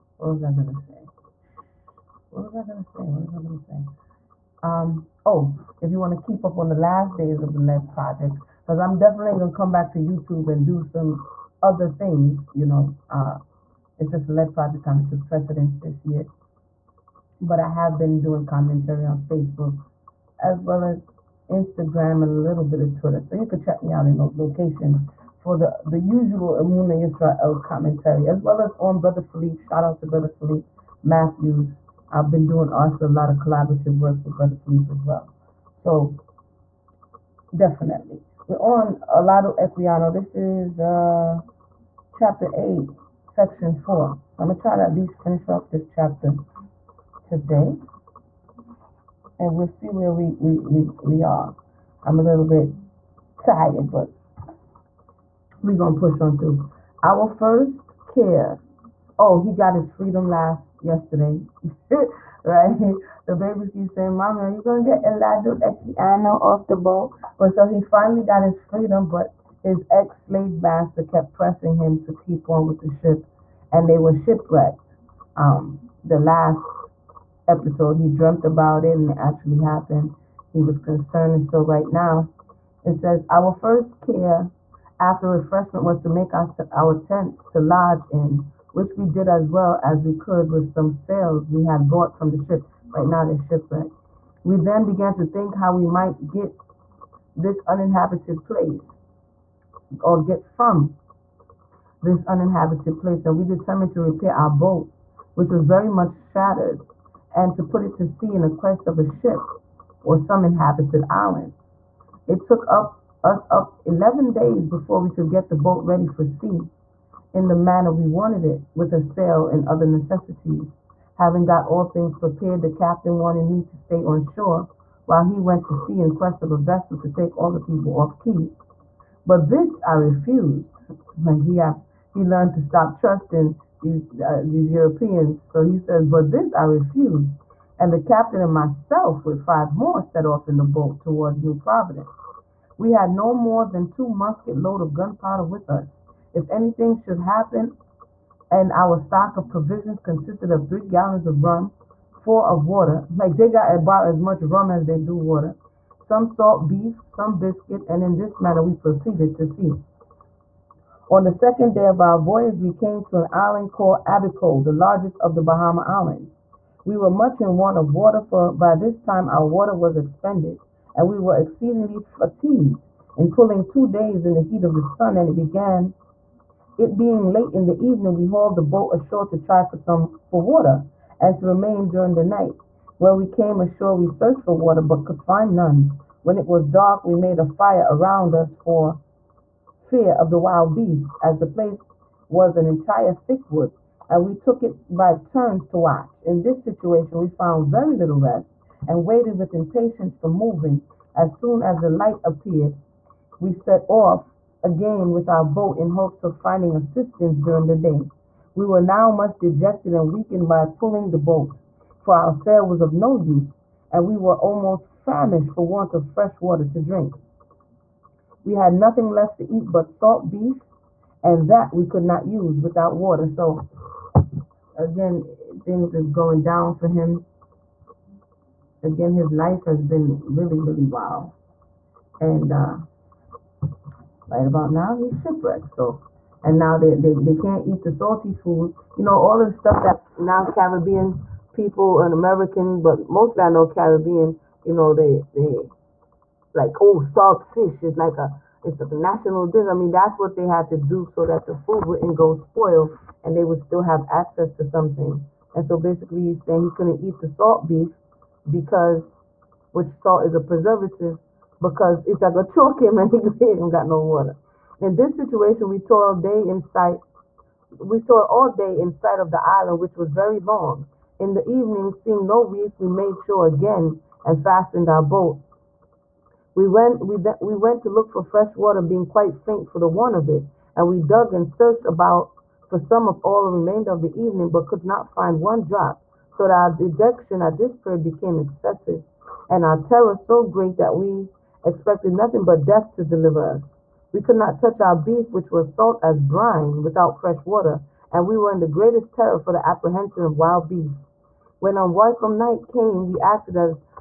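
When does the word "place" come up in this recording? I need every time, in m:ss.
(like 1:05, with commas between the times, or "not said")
1:38, 1:43, 3:11.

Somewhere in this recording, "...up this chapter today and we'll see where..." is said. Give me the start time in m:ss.
0:45.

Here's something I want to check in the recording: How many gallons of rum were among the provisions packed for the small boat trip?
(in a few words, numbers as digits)
3.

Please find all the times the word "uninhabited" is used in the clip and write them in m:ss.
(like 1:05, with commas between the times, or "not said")
1:37, 1:42.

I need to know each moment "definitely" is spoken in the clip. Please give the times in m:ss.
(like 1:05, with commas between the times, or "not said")
0:08, 0:37.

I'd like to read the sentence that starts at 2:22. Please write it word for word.
We had no more than two musket load of gunpowder with us.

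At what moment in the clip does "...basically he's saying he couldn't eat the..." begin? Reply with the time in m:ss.
4:15.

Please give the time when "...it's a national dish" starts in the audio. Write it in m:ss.
4:08.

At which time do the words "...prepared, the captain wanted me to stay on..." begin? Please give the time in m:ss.
2:02.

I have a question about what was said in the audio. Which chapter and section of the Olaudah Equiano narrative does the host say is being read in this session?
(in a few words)
Chapter 8, section 4.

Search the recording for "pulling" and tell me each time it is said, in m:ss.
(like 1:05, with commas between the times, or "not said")
2:53, 3:30.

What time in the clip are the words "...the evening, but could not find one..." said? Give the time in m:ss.
4:44.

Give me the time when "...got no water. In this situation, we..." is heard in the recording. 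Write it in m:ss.
4:23.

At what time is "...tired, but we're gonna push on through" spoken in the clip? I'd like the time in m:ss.
0:53.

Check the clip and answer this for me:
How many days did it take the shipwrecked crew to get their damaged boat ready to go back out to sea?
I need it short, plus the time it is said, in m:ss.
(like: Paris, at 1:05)
11, at 1:53.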